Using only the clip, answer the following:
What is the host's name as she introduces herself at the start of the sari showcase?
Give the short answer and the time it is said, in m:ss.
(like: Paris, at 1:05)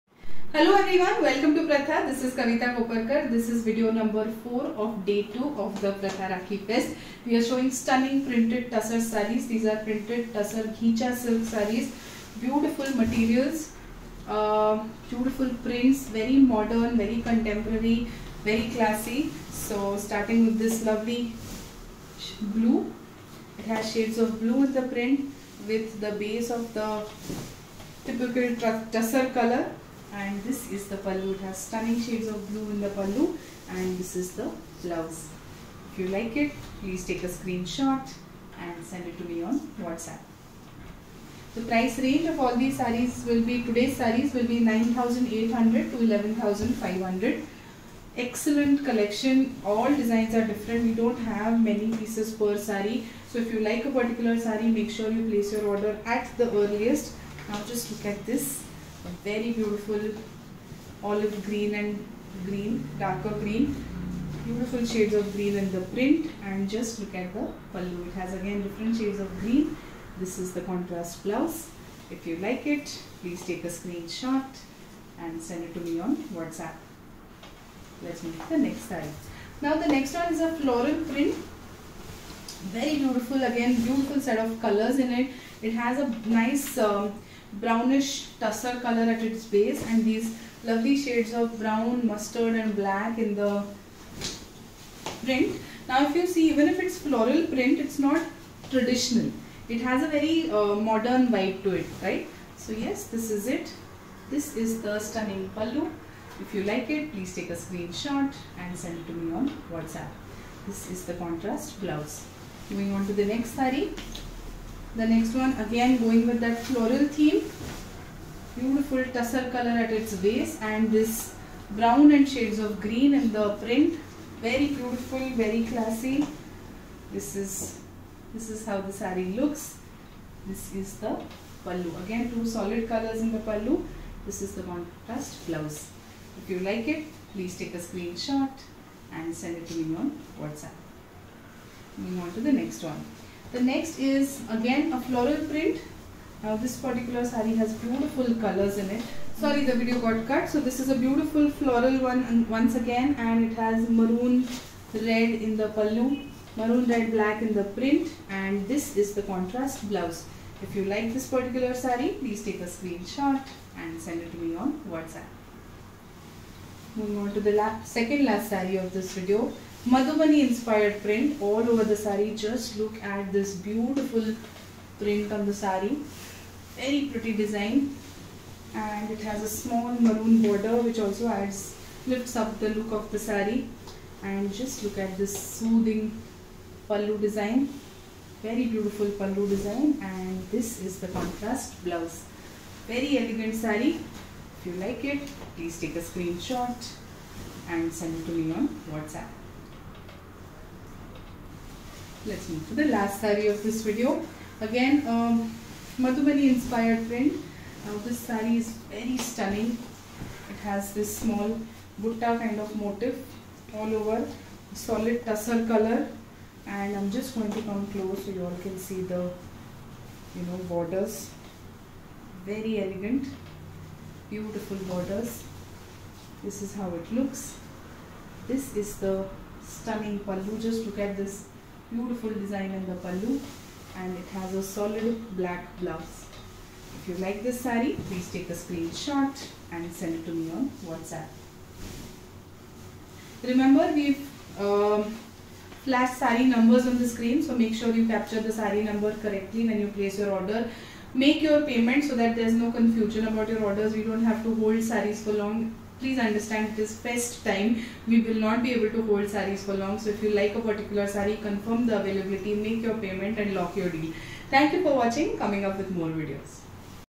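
Kavita Koparkar, at 0:02.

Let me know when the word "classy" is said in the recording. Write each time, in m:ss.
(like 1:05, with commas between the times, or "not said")
0:18, 2:05.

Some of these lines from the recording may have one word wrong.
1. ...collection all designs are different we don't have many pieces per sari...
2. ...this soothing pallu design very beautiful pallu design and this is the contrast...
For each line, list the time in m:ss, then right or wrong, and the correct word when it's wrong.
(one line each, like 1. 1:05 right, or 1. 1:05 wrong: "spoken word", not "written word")
1. 0:48 right
2. 3:05 right.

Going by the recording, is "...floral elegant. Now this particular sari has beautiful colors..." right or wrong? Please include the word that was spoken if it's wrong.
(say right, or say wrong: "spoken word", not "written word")
wrong: "print", not "elegant".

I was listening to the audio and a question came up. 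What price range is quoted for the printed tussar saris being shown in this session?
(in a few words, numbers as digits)
9800 to 11500.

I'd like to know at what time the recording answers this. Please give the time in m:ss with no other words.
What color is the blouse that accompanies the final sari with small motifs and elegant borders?
3:54.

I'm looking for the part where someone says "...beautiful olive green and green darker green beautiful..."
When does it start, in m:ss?
0:59.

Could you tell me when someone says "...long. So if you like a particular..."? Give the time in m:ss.
4:19.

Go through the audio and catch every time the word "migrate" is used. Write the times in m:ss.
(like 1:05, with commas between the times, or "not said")
not said.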